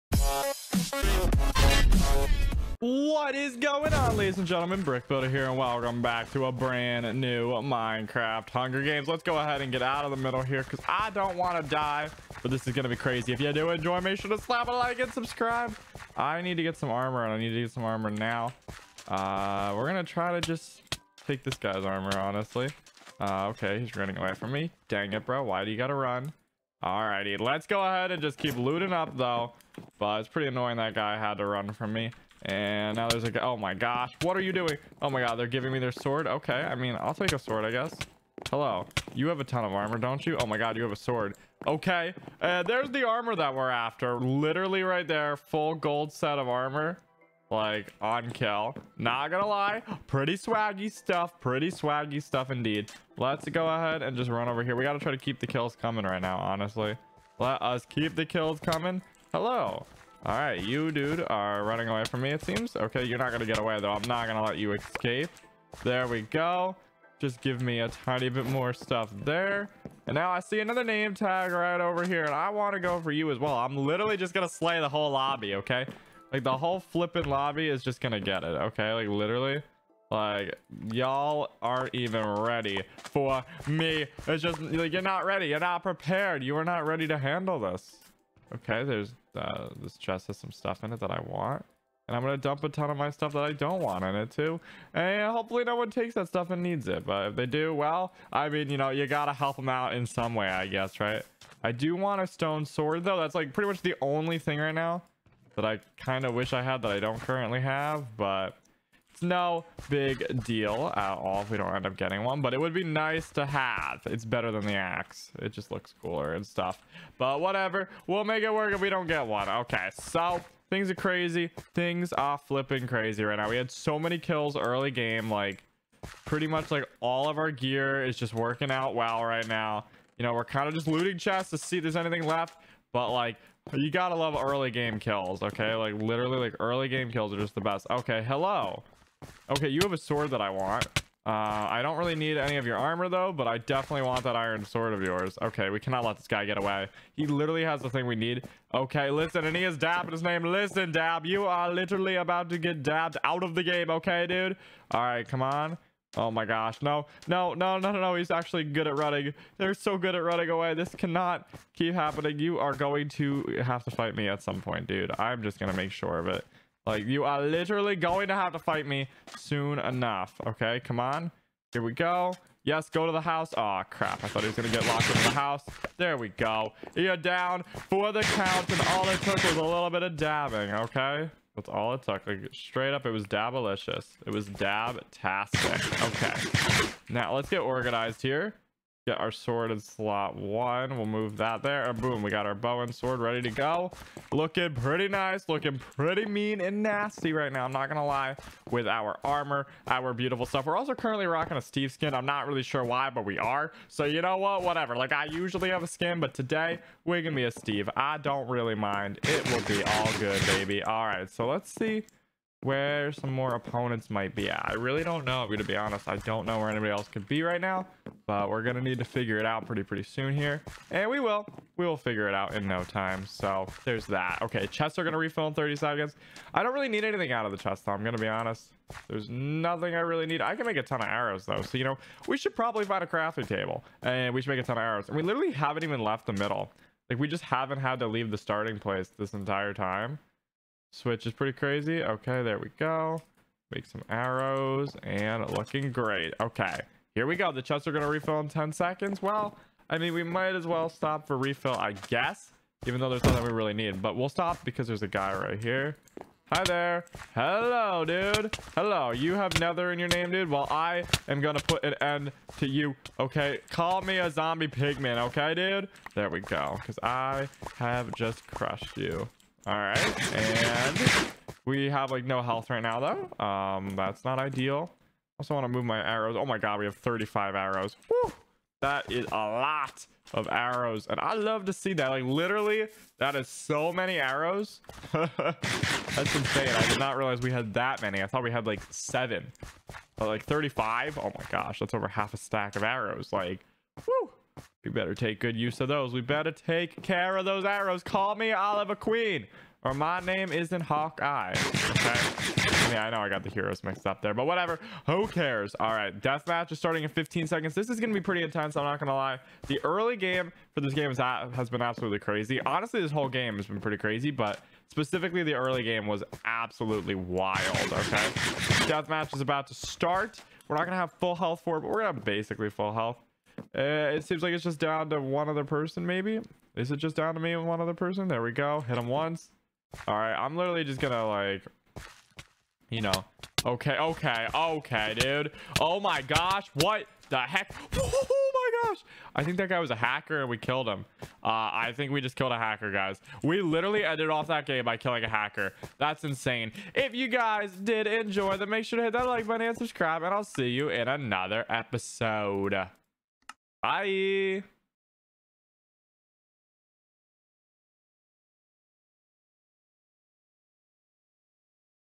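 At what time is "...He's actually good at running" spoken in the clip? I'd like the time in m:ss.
2:38.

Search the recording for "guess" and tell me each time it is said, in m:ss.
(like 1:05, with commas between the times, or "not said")
0:37, 1:40, 4:12.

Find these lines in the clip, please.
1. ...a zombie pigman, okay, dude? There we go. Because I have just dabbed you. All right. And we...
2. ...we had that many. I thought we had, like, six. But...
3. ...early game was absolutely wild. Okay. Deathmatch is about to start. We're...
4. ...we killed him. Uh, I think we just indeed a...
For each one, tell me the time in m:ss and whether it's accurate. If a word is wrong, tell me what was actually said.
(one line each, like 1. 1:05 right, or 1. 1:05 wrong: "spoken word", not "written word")
1. 4:24 wrong: "crushed", not "dabbed"
2. 4:47 wrong: "seven", not "six"
3. 5:15 right
4. 5:40 wrong: "killed", not "indeed".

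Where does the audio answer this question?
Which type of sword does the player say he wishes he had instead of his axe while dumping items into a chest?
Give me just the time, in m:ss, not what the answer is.
1:42.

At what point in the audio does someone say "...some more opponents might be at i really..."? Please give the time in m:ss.
3:33.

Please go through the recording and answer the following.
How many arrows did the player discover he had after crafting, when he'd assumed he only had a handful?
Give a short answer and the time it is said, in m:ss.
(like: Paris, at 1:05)
35, at 4:36.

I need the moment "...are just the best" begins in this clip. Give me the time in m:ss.
2:17.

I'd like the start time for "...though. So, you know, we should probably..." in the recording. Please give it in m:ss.
3:51.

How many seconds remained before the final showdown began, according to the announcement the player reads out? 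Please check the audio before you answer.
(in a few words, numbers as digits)
15.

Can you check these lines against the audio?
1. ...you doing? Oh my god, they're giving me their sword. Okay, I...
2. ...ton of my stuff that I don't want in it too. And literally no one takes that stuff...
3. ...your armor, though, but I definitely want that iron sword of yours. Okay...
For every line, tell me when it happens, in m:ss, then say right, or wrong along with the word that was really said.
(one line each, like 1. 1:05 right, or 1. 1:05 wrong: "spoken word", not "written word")
1. 0:34 right
2. 1:32 wrong: "hopefully", not "literally"
3. 2:22 right.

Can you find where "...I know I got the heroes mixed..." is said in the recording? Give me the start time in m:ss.
5:03.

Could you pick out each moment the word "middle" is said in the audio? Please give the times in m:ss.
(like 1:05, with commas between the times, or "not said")
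0:10, 3:56.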